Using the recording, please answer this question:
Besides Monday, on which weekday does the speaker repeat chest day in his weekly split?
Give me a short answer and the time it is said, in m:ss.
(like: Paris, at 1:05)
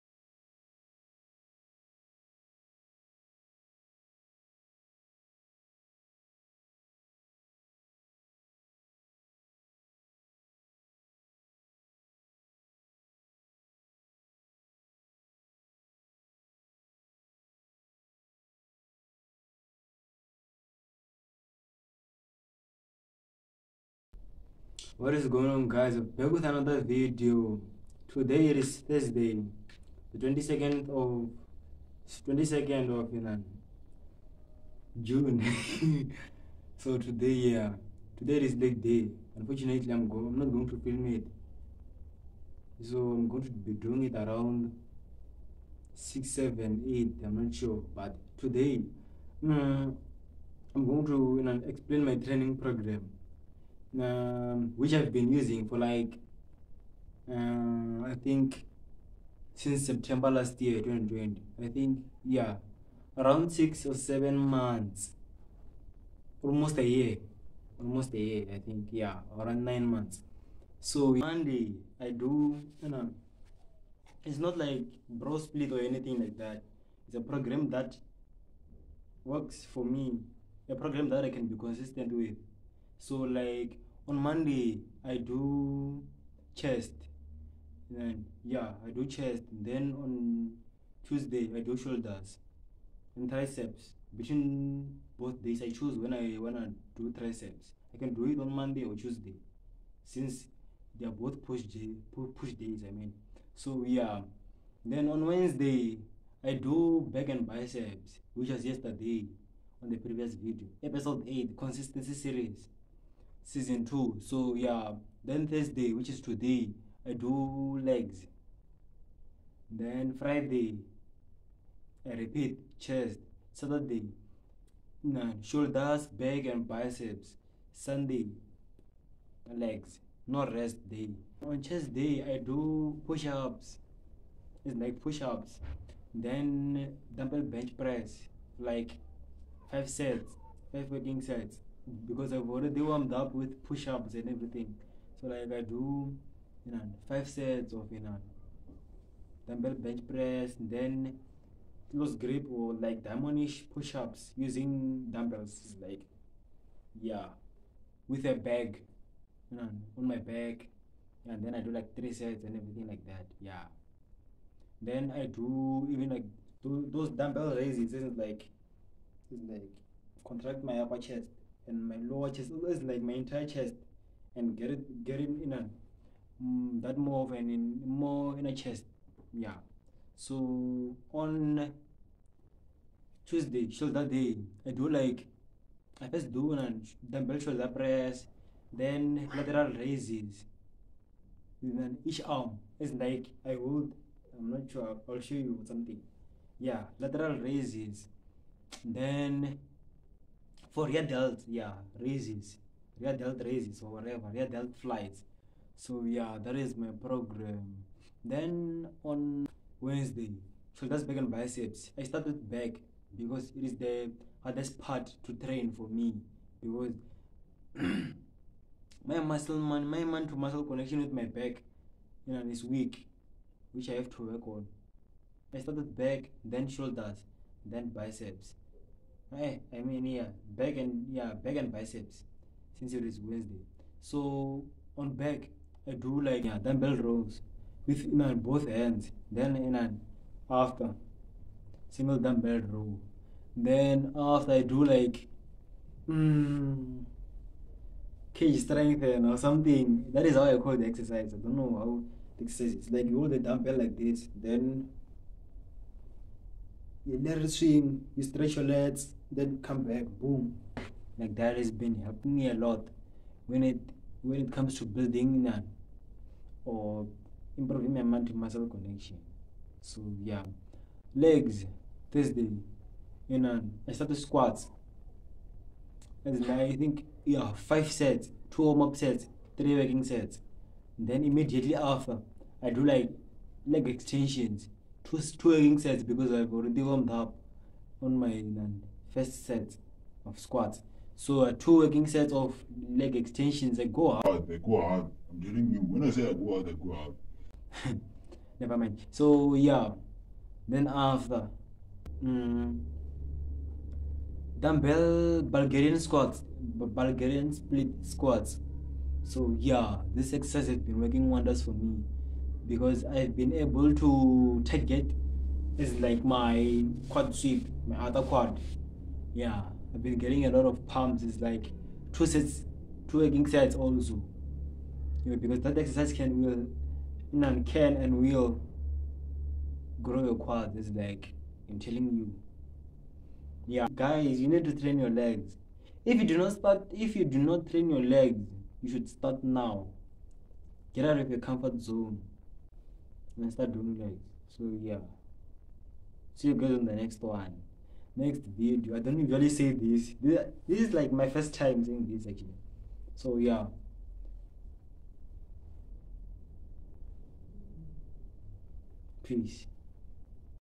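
Friday, at 2:00.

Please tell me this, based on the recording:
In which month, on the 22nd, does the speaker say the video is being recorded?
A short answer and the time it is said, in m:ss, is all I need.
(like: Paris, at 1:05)
June, at 0:35.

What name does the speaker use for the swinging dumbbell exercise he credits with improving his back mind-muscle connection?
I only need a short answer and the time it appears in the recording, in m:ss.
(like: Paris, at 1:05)
cage strength, at 4:08.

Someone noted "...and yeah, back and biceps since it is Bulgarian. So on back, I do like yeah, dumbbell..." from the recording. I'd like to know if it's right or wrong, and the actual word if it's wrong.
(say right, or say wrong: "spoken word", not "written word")
wrong: "Wednesday", not "Bulgarian".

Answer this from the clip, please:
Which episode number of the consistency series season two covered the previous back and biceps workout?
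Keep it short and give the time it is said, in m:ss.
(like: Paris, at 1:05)
8, at 1:50.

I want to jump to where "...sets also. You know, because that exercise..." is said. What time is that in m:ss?
5:23.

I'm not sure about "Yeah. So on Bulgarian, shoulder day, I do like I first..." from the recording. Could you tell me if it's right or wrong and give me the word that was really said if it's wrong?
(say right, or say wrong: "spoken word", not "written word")
wrong: "Tuesday", not "Bulgarian".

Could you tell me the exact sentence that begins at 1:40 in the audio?
Since they are both push day, push days, I mean.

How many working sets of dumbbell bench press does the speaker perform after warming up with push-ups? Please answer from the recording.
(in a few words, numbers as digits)
5.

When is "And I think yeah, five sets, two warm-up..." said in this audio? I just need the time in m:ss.
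4:36.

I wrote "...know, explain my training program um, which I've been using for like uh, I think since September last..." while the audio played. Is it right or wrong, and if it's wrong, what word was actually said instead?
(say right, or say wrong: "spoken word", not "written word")
right.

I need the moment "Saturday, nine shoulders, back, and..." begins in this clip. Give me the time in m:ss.
2:03.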